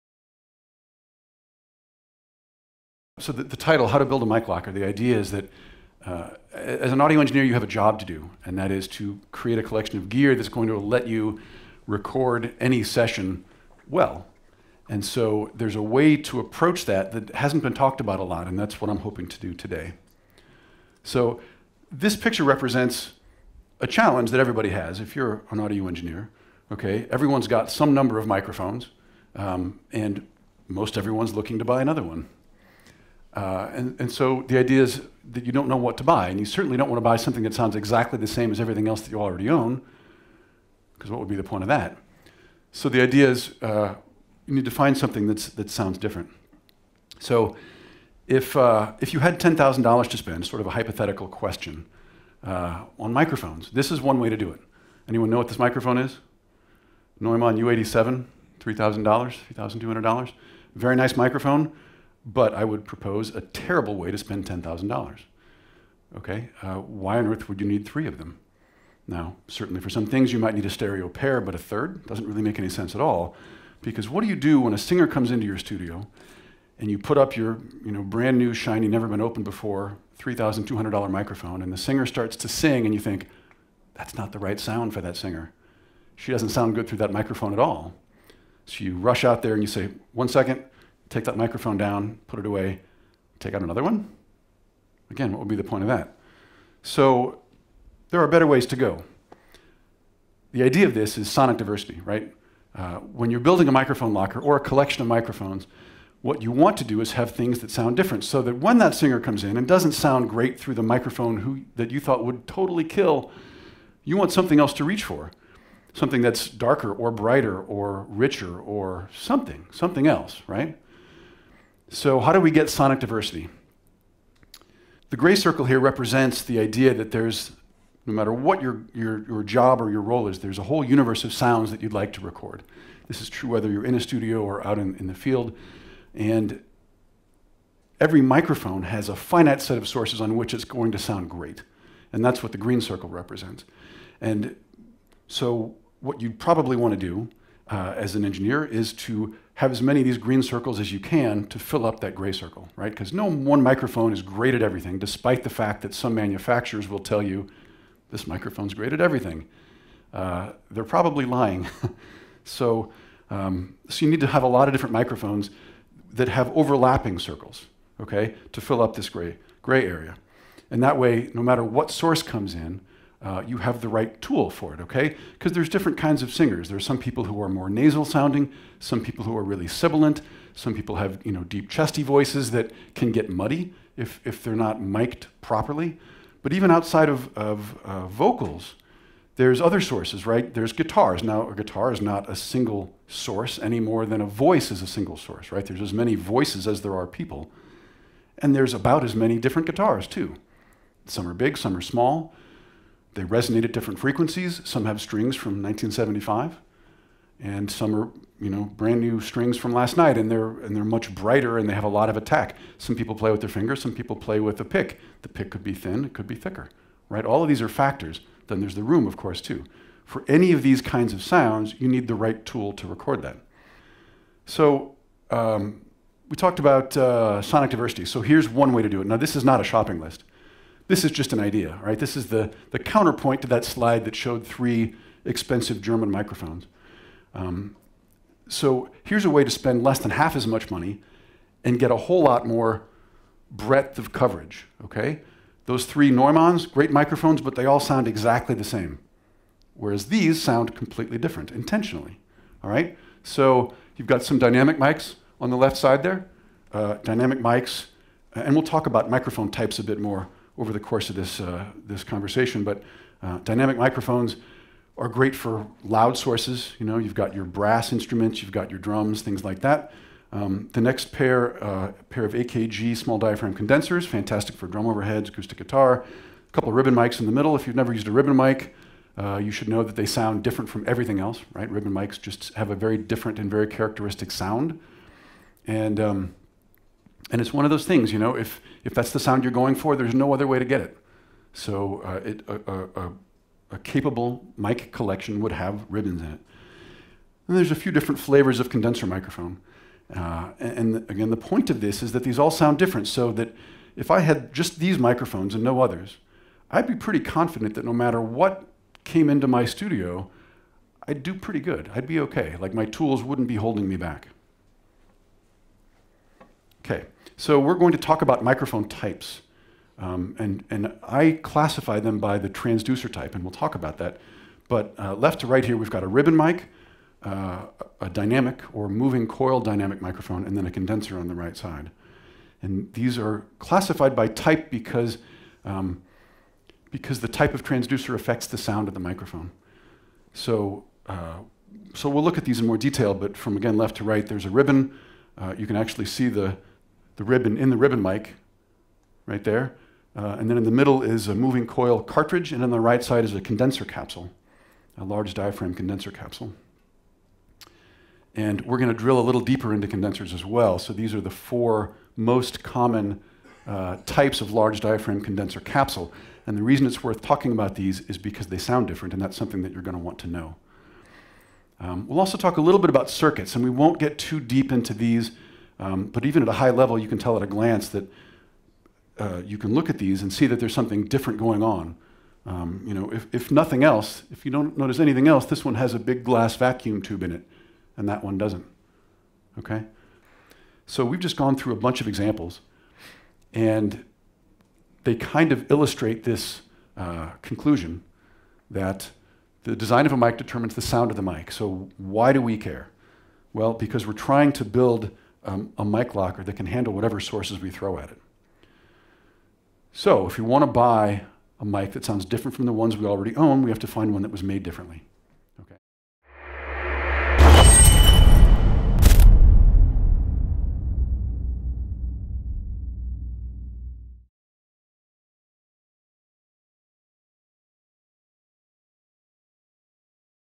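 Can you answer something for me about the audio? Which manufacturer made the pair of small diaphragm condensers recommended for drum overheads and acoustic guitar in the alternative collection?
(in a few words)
AKG.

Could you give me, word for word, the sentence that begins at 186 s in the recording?
But even outside of, of uh, vocals, there's other sources, right?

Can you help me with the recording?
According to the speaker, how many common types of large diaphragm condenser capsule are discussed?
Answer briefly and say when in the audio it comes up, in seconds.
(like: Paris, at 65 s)
4, at 361 s.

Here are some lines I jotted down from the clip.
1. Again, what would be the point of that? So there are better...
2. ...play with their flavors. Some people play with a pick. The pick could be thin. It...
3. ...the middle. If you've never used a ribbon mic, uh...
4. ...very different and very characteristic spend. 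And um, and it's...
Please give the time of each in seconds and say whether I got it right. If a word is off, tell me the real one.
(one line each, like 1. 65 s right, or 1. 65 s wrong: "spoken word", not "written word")
1. 95 s right
2. 213 s wrong: "fingers", not "flavors"
3. 277 s right
4. 282 s wrong: "sound", not "spend".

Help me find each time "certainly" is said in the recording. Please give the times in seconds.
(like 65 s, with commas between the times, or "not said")
36 s, 69 s.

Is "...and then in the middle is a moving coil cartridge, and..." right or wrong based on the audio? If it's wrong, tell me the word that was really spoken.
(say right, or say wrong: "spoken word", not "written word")
right.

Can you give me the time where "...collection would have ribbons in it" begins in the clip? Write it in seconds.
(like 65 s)
294 s.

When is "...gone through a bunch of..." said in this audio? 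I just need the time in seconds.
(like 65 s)
391 s.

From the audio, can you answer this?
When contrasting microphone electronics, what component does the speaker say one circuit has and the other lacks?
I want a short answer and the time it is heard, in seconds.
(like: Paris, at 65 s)
vacuum tube, at 386 s.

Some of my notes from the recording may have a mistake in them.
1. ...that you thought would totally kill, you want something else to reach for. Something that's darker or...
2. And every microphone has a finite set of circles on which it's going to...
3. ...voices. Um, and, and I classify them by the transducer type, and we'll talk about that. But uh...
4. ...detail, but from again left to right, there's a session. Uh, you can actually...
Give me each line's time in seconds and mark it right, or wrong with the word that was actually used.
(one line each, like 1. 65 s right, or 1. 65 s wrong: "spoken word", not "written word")
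1. 111 s right
2. 136 s wrong: "sources", not "circles"
3. 318 s wrong: "types", not "voices"
4. 342 s wrong: "ribbon", not "session".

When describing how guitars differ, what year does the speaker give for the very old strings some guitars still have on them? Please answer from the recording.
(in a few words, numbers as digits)
1975.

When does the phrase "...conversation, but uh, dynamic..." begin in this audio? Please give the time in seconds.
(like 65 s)
262 s.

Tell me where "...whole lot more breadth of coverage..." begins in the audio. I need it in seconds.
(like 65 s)
241 s.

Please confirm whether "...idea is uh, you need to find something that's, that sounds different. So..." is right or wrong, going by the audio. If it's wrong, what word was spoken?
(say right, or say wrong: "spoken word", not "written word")
right.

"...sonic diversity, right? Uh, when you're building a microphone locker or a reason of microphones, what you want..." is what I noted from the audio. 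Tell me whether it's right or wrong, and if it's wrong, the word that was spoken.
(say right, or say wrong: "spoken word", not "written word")
wrong: "collection", not "reason".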